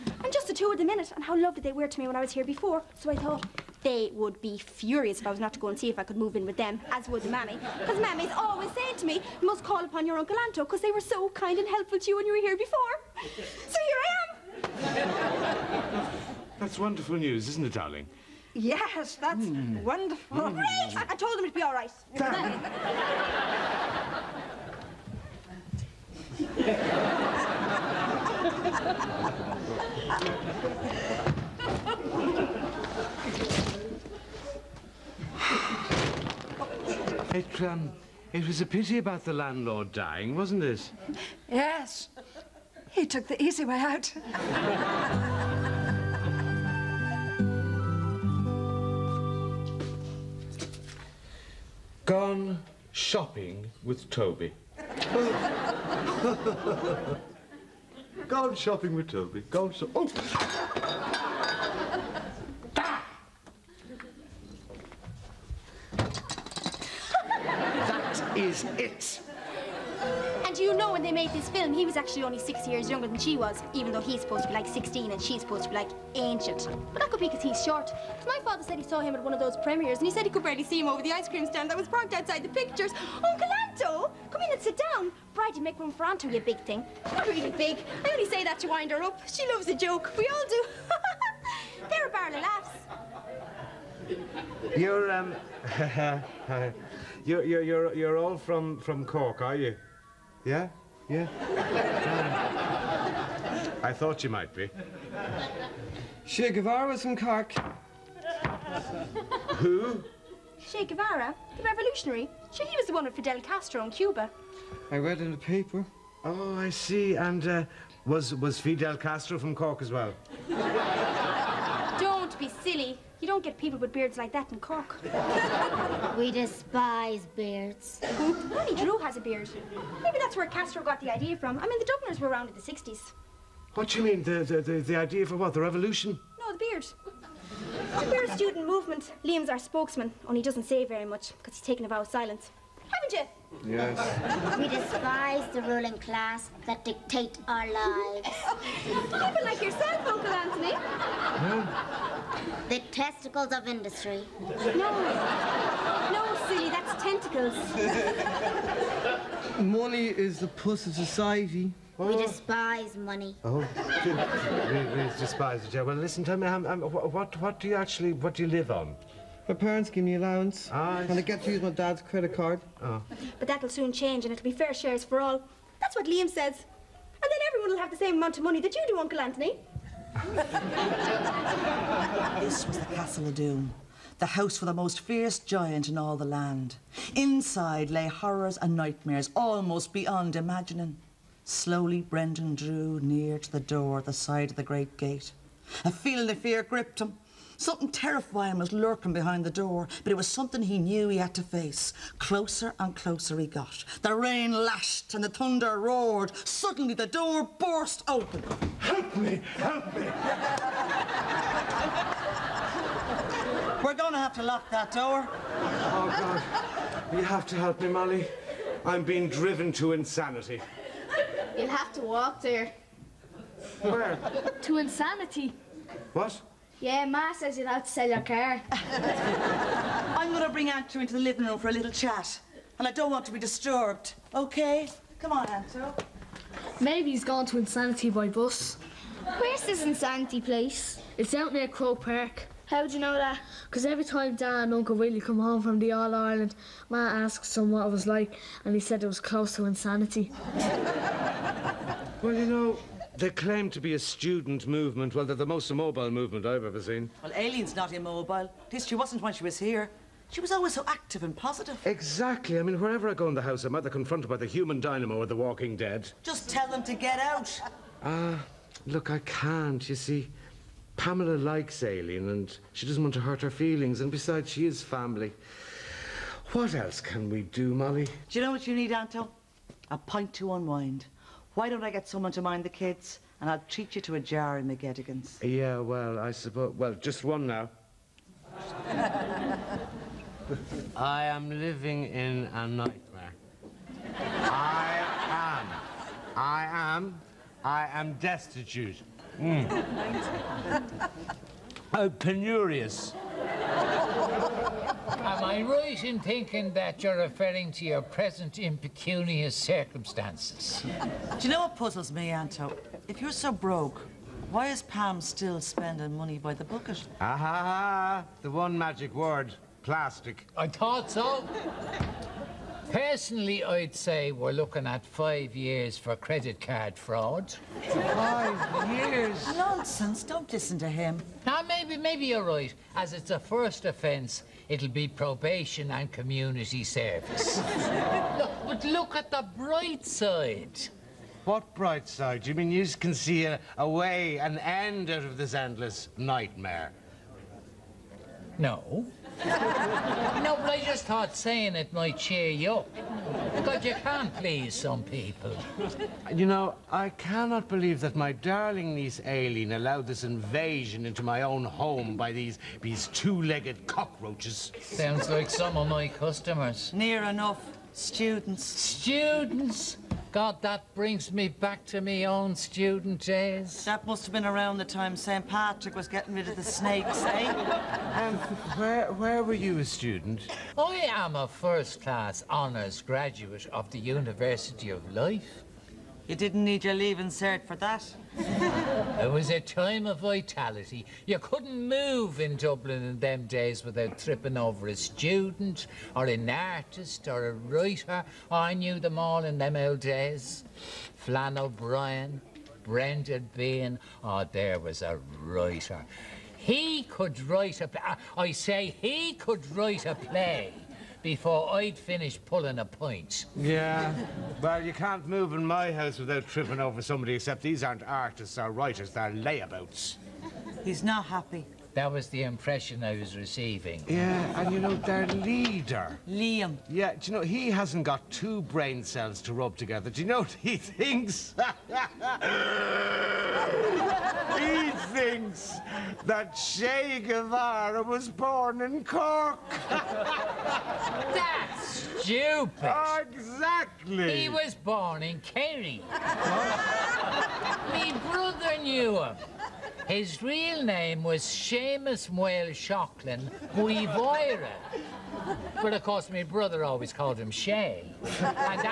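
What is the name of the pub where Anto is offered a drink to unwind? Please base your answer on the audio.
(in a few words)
McGettigan's.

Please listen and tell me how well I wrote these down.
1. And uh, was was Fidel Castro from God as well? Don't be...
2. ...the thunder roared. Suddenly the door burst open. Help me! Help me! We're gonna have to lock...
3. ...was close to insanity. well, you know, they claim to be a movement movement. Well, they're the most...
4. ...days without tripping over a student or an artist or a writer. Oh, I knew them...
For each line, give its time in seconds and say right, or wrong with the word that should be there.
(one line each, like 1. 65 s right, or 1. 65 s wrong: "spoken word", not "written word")
1. 117 s wrong: "Cork", not "God"
2. 205 s right
3. 249 s wrong: "student", not "movement"
4. 393 s right.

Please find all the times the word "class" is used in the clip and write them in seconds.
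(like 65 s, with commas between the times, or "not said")
145 s, 381 s.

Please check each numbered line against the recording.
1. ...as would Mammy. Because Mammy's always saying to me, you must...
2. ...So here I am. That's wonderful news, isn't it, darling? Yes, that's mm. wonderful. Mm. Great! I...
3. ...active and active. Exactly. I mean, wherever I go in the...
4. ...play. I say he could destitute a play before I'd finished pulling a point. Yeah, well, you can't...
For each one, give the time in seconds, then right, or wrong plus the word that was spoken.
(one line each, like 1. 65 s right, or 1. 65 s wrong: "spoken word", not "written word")
1. 6 s right
2. 13 s right
3. 260 s wrong: "positive", not "active"
4. 407 s wrong: "write", not "destitute".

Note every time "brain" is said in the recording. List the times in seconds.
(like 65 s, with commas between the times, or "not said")
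428 s.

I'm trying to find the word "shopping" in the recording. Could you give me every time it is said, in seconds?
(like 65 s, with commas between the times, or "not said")
52 s, 58 s.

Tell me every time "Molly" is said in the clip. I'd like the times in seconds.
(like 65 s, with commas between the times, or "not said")
217 s, 277 s.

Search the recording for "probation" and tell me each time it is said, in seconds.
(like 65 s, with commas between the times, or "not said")
335 s.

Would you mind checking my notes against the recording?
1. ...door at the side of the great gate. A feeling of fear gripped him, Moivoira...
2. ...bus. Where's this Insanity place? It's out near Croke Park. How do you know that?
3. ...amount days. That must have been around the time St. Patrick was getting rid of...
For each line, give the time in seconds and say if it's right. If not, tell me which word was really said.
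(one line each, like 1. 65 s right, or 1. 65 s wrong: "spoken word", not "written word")
1. 193 s wrong: "Something", not "Moivoira"
2. 238 s right
3. 372 s wrong: "student", not "amount".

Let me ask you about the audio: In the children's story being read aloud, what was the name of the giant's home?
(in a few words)
Castle of Doom.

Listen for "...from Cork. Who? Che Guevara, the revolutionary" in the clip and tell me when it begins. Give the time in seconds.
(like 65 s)
107 s.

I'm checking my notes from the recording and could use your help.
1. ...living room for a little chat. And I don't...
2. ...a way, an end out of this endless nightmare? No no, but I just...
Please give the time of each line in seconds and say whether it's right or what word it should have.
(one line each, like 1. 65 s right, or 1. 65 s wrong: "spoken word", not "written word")
1. 231 s right
2. 343 s right.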